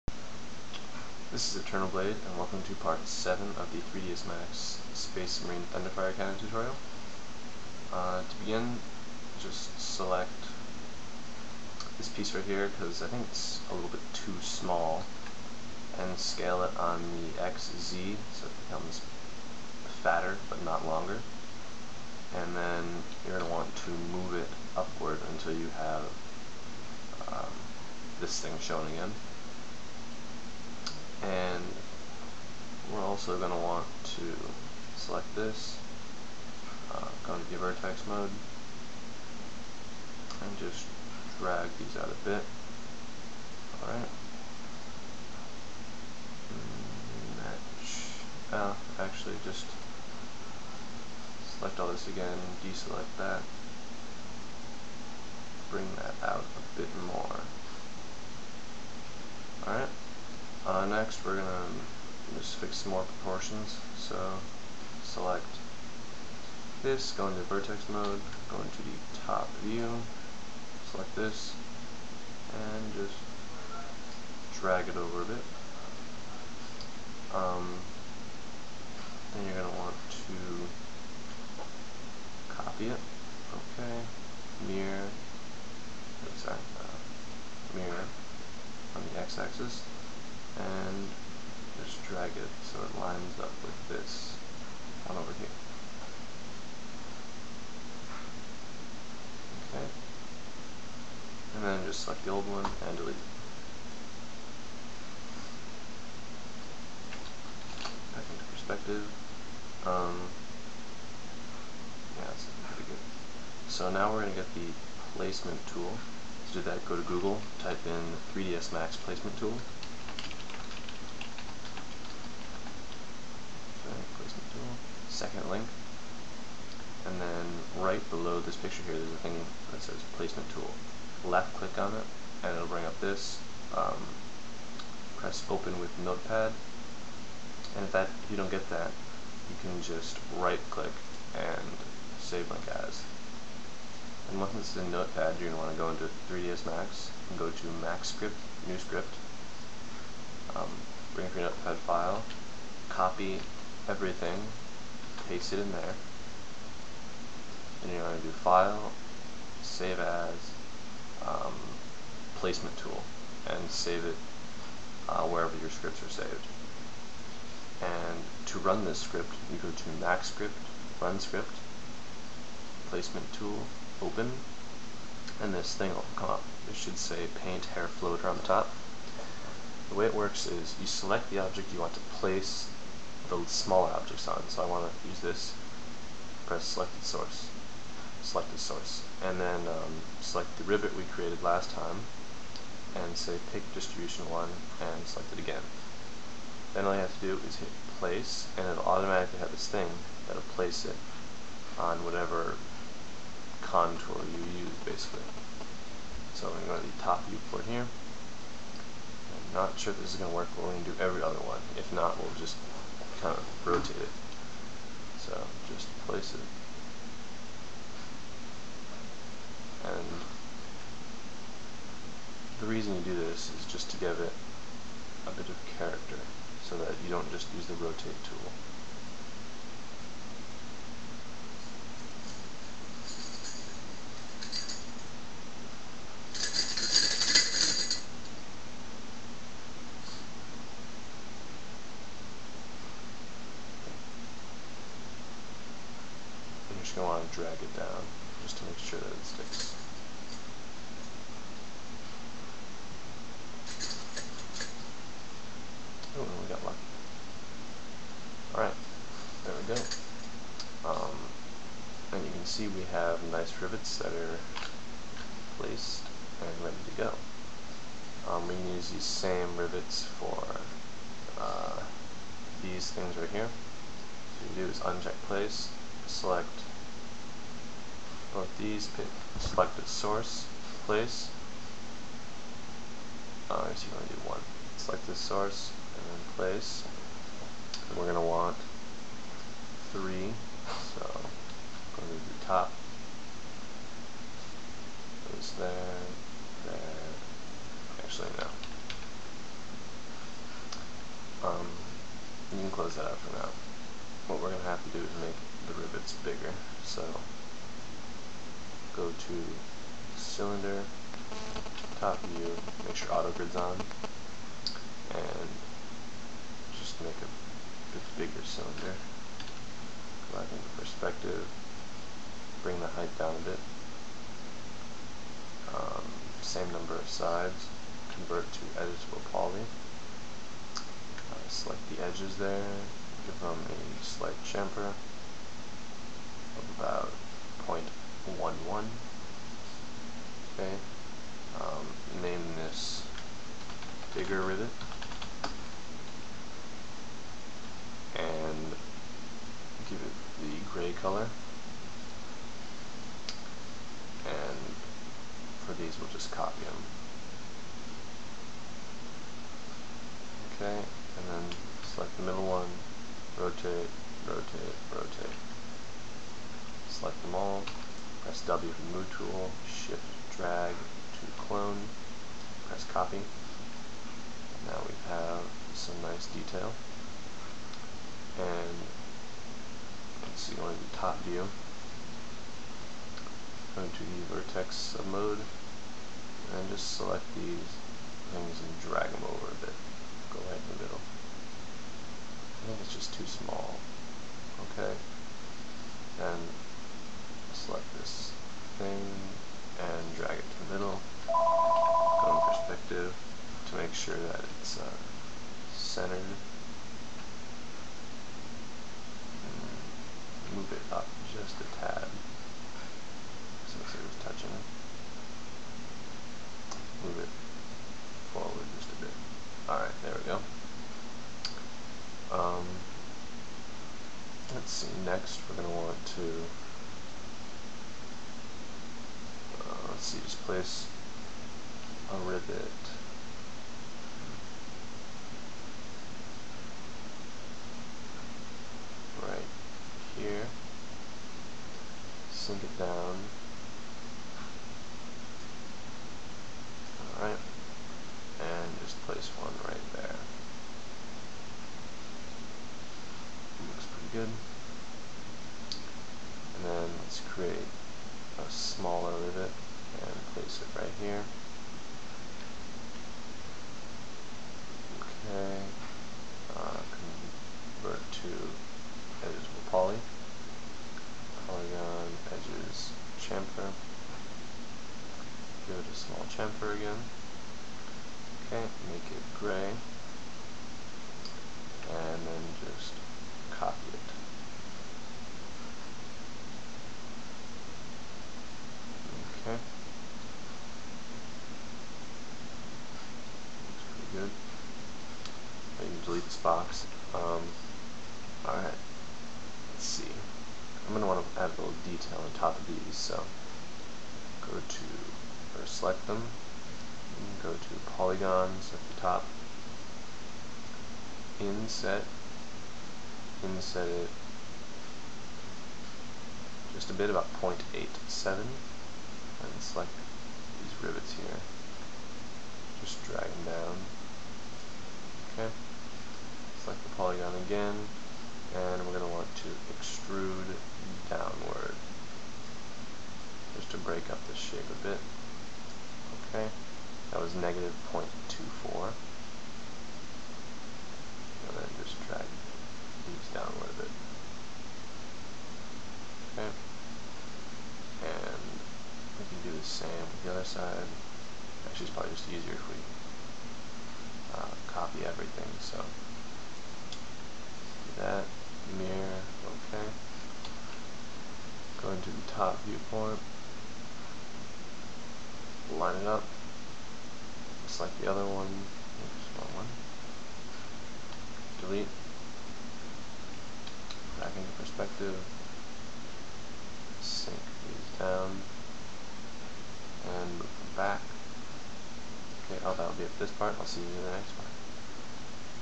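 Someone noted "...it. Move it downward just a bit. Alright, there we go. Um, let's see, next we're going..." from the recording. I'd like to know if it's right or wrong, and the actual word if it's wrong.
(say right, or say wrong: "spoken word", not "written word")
wrong: "forward", not "downward".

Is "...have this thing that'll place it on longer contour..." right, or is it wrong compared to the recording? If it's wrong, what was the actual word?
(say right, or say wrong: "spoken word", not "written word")
wrong: "whatever", not "longer".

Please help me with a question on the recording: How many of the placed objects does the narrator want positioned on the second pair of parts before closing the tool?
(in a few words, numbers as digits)
3.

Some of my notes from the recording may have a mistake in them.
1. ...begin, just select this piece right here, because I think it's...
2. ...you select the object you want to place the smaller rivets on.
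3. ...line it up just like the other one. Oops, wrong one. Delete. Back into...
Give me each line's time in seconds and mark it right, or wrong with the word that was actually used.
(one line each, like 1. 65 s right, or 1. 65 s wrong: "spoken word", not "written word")
1. 8 s right
2. 180 s wrong: "objects", not "rivets"
3. 565 s right.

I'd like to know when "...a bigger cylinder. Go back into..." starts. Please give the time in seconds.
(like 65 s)
317 s.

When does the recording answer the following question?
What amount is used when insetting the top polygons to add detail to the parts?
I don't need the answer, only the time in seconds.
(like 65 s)
517 s.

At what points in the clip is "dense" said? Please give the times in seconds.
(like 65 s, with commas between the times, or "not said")
not said.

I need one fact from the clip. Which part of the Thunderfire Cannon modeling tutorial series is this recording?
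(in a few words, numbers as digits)
7.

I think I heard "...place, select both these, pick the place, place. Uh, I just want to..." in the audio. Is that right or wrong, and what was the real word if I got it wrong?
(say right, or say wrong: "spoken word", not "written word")
wrong: "source", not "place".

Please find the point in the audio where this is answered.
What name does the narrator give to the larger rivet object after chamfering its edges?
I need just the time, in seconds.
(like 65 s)
344 s.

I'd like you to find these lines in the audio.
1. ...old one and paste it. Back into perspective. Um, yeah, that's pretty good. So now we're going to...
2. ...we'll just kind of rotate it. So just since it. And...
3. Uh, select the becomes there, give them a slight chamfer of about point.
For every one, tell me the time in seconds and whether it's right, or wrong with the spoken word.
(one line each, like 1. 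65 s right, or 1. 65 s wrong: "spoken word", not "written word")
1. 102 s wrong: "delete", not "paste"
2. 212 s wrong: "place", not "since"
3. 330 s wrong: "edges", not "becomes".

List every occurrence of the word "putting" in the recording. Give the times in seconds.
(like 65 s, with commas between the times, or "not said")
not said.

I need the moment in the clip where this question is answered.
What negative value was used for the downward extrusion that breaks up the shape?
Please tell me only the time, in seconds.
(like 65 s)
537 s.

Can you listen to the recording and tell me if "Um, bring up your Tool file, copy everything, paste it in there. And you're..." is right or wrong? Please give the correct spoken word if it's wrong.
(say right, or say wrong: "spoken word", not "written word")
wrong: "Notepad", not "Tool".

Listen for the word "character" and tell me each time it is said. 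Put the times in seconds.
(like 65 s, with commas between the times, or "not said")
225 s.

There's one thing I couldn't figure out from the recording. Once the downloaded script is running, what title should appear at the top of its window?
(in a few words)
Paint Hair Floater.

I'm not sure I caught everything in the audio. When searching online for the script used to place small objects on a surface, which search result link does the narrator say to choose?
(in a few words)
second link.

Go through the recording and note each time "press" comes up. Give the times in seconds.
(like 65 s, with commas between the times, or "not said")
135 s, 186 s, 368 s, 372 s.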